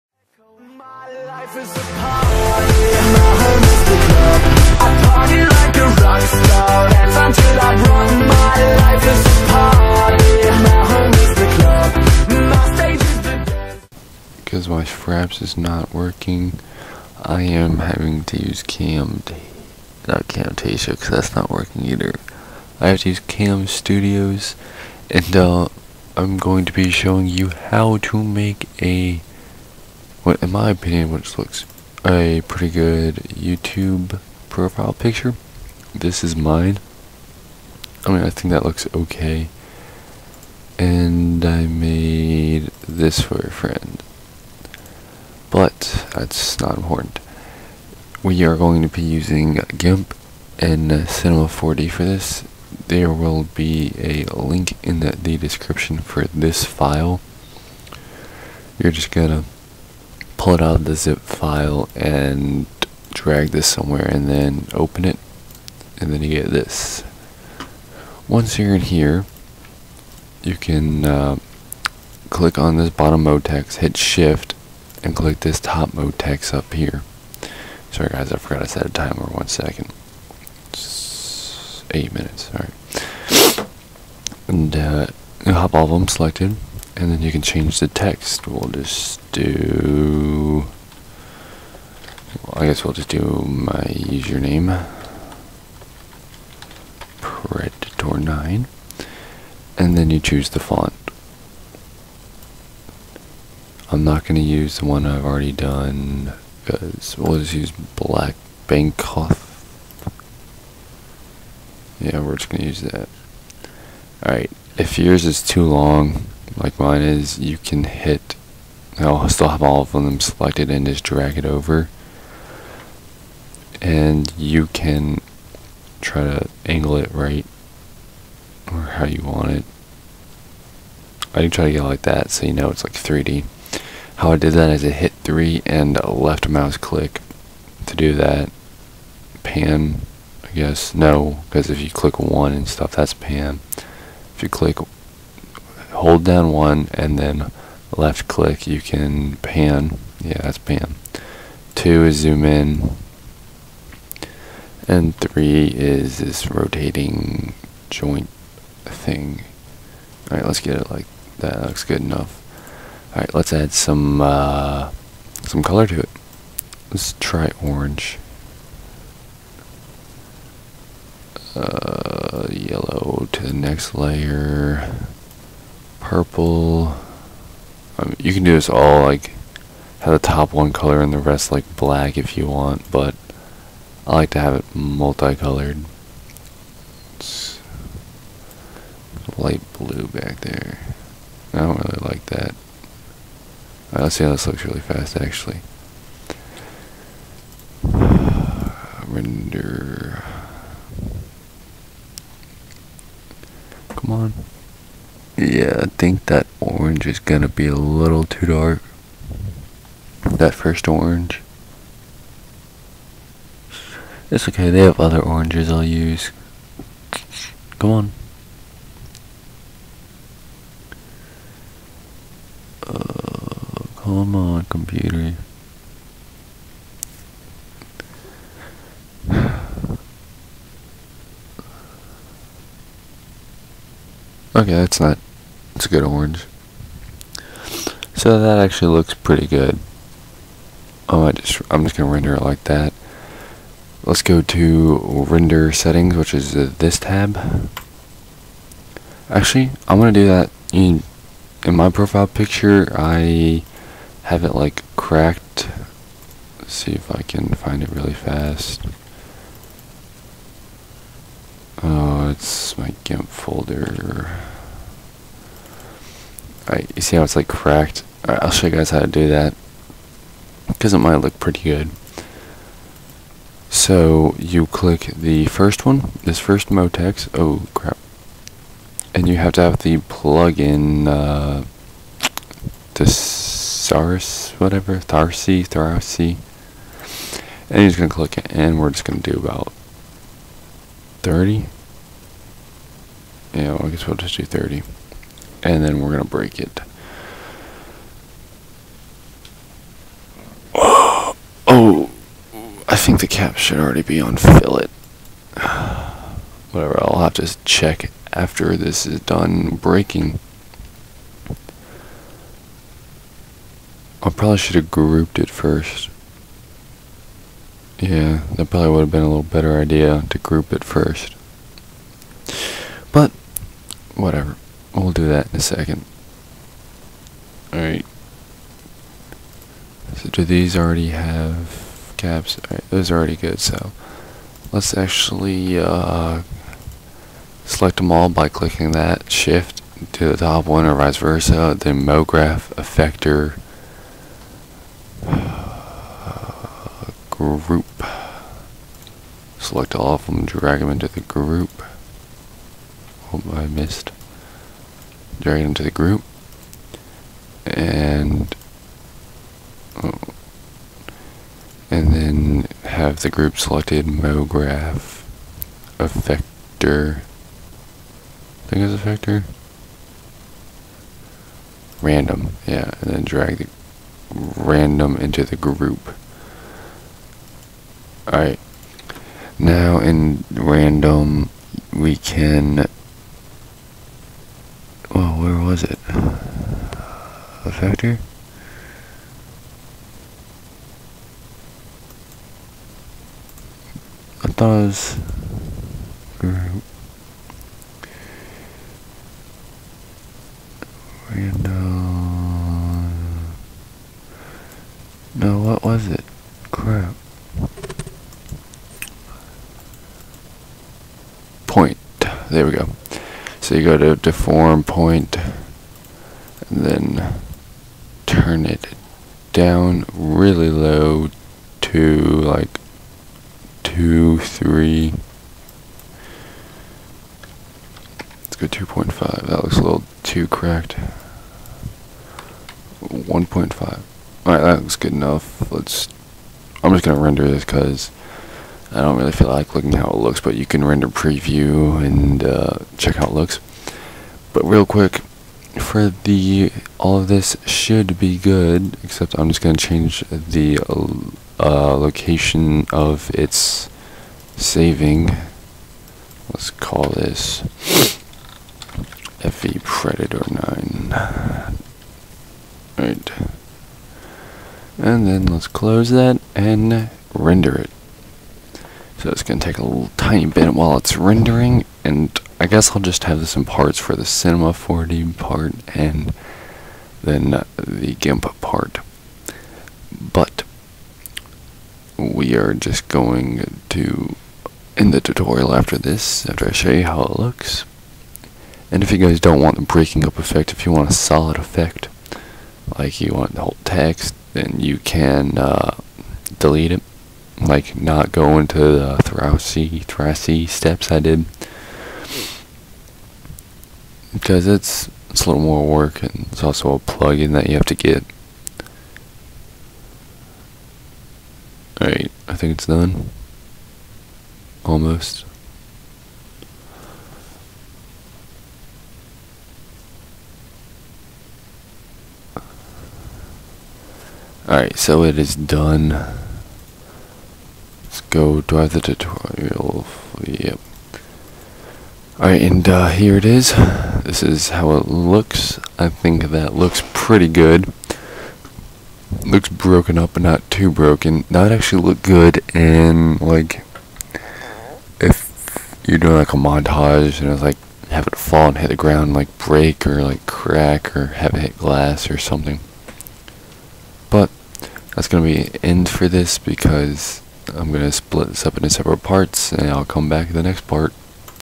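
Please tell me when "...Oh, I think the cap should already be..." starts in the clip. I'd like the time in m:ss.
5:01.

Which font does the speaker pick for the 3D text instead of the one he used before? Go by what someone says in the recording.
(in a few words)
Black Bangkok.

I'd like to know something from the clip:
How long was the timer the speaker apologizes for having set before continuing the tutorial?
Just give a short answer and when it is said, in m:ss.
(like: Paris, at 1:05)
8 minutes, at 1:21.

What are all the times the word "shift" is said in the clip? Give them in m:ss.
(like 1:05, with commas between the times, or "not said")
1:13, 5:39.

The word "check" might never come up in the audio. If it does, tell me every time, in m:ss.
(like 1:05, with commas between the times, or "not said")
5:07, 7:22.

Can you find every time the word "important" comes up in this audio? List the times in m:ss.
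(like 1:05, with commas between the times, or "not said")
0:46.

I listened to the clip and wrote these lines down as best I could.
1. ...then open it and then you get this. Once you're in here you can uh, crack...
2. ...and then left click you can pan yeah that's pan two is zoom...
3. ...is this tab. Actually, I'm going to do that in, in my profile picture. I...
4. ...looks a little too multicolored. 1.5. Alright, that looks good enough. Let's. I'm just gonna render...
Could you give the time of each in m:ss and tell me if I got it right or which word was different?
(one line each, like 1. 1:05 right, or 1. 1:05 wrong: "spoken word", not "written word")
1. 1:04 wrong: "click", not "crack"
2. 2:26 right
3. 4:06 right
4. 7:09 wrong: "cracked", not "multicolored".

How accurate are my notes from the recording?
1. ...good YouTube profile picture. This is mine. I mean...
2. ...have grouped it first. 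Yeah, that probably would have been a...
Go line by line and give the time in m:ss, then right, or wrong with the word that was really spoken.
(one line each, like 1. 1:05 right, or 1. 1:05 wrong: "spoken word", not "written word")
1. 0:32 right
2. 5:14 right.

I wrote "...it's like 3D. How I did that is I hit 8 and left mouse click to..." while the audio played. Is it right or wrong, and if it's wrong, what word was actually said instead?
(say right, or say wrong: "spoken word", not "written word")
wrong: "3", not "8".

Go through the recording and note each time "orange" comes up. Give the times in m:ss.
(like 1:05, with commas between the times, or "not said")
2:47, 3:26, 3:30, 3:35, 3:56.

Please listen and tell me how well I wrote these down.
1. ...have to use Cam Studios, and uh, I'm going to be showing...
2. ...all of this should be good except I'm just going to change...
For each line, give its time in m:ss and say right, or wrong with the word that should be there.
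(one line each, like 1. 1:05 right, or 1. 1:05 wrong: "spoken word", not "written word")
1. 0:22 right
2. 7:26 right.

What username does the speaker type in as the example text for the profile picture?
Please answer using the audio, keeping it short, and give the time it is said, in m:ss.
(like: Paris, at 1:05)
Predator9, at 1:37.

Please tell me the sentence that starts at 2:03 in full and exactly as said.
And you can try to angle it right or how you want it.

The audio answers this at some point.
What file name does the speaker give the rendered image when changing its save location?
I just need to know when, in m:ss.
7:39.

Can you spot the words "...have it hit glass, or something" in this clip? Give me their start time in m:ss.
9:11.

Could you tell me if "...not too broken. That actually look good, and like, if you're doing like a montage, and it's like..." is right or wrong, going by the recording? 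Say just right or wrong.
right.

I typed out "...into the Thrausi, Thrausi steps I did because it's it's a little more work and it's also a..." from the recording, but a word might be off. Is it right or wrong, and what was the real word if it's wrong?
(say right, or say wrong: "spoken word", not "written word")
right.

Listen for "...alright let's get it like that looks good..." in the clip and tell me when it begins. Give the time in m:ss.
2:40.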